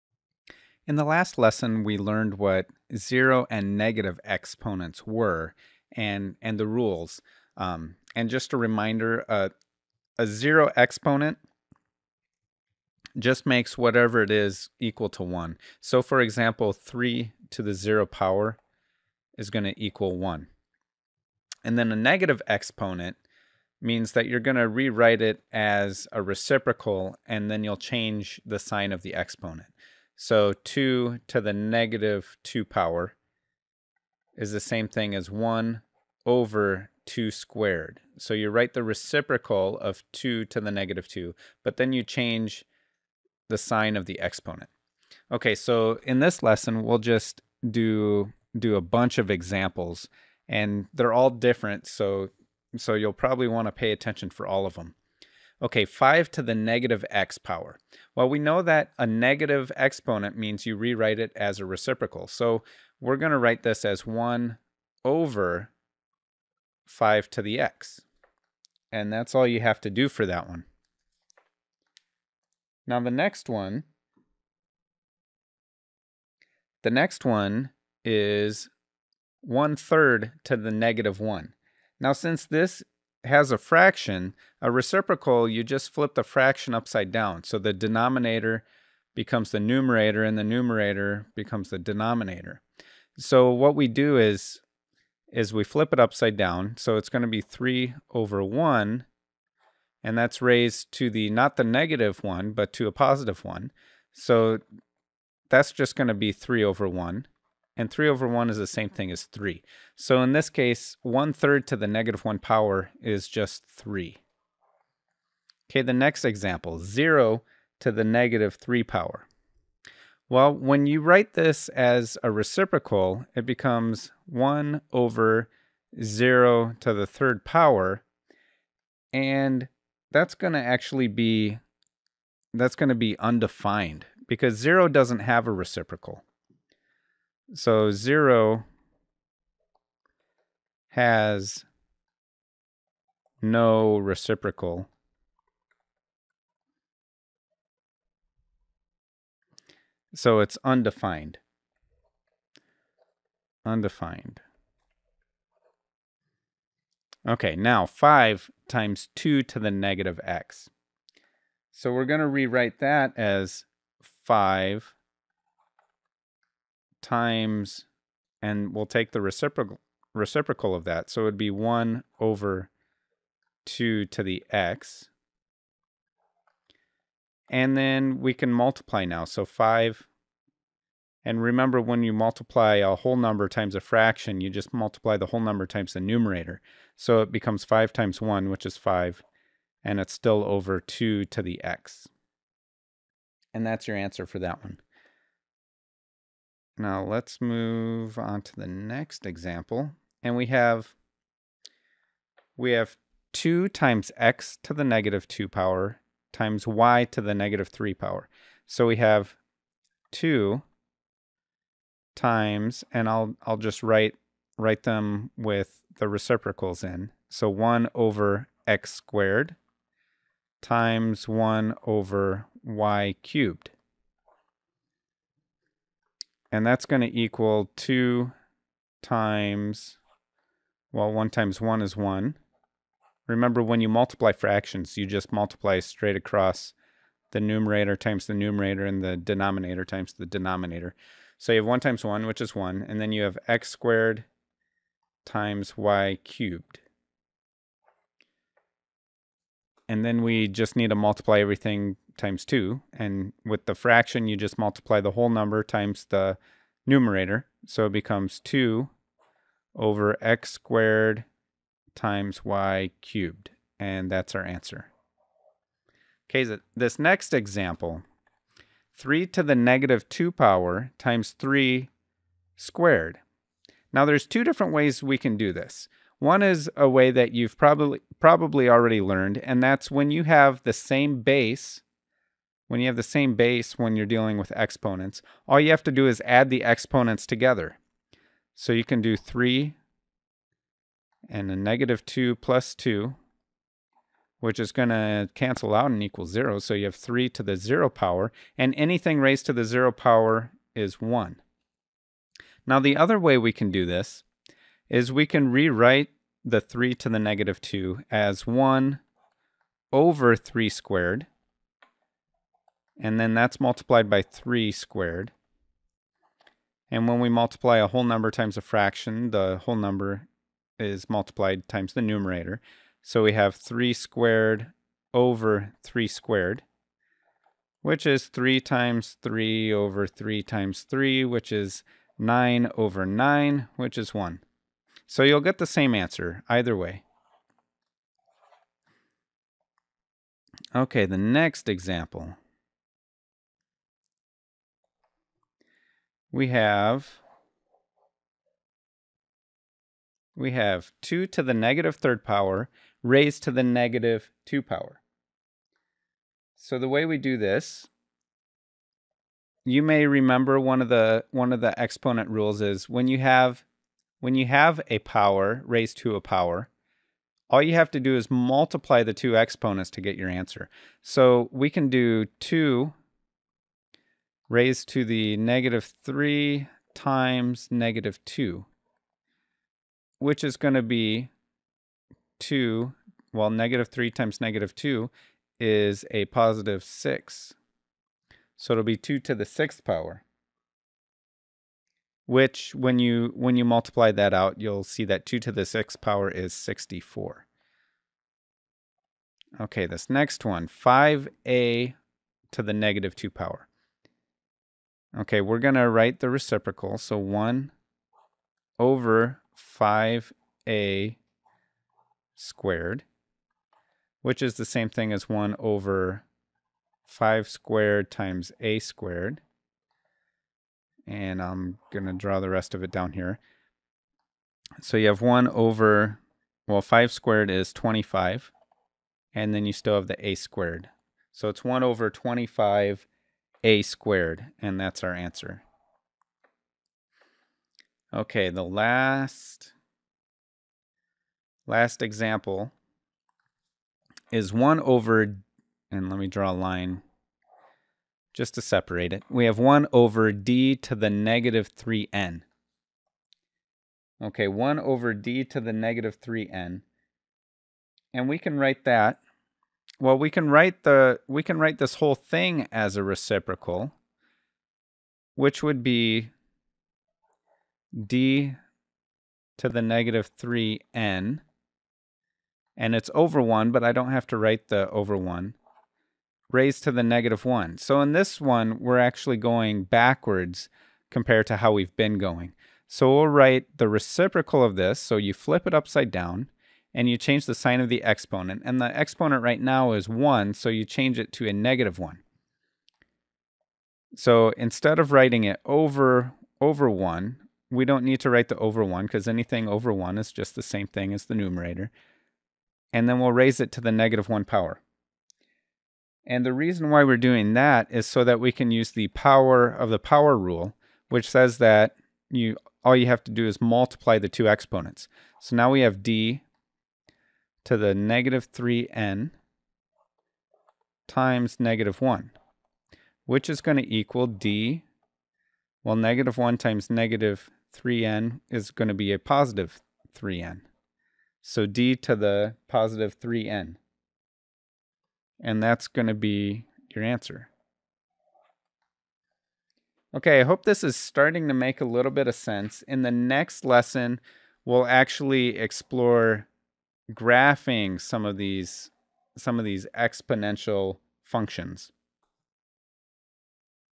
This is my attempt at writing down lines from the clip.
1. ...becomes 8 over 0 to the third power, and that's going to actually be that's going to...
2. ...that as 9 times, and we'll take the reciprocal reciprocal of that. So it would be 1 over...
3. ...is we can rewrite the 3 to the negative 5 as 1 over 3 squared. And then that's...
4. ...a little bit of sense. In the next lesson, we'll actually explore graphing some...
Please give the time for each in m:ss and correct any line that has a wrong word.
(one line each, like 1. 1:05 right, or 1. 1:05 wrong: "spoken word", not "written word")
1. 2:03 wrong: "1", not "8"
2. 2:42 wrong: "5", not "9"
3. 5:04 wrong: "2", not "5"
4. 9:01 right.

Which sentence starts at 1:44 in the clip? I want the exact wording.
So that's just going to be 3 over 1 and 3 over 1 is the same thing as 3.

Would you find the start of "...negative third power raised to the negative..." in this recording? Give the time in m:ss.
5:51.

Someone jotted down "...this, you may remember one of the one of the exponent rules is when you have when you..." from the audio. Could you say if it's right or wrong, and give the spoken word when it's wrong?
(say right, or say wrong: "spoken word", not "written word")
right.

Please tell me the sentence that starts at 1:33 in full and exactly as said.
So what we do is, is we flip it upside down.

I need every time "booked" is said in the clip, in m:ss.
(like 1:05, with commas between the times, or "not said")
not said.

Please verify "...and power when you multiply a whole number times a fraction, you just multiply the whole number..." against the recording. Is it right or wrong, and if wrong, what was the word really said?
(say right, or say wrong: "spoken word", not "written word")
wrong: "remember", not "power".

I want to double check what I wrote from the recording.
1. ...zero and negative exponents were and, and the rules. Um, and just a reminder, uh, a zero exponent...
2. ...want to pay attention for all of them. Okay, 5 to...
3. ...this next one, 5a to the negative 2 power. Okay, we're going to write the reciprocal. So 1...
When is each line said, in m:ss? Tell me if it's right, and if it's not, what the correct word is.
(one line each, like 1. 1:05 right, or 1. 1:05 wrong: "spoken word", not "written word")
1. 0:02 right
2. 0:53 right
3. 6:39 right.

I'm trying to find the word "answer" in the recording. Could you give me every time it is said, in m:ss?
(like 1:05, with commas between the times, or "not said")
3:13, 4:24, 5:35, 6:10, 7:15, 8:57.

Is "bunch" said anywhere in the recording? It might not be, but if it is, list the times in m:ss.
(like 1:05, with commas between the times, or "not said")
0:48.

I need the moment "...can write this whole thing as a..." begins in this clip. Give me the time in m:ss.
7:41.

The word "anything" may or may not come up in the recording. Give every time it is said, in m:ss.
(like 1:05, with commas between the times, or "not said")
4:58, 8:19.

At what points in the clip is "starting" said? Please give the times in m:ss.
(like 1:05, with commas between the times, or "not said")
9:00.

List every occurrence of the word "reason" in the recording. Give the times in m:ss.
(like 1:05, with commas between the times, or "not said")
8:26.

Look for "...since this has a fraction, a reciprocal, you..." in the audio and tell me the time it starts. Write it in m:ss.
1:22.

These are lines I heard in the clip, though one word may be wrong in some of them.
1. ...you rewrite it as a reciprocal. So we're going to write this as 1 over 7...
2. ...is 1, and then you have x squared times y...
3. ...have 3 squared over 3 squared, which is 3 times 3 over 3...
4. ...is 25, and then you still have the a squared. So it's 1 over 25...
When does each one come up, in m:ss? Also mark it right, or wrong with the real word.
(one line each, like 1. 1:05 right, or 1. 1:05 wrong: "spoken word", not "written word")
1. 1:00 wrong: "5", not "7"
2. 4:02 right
3. 5:23 right
4. 7:07 right.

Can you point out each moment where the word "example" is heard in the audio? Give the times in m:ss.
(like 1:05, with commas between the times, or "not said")
0:16, 0:49, 1:56, 3:19, 4:27, 5:41, 7:22.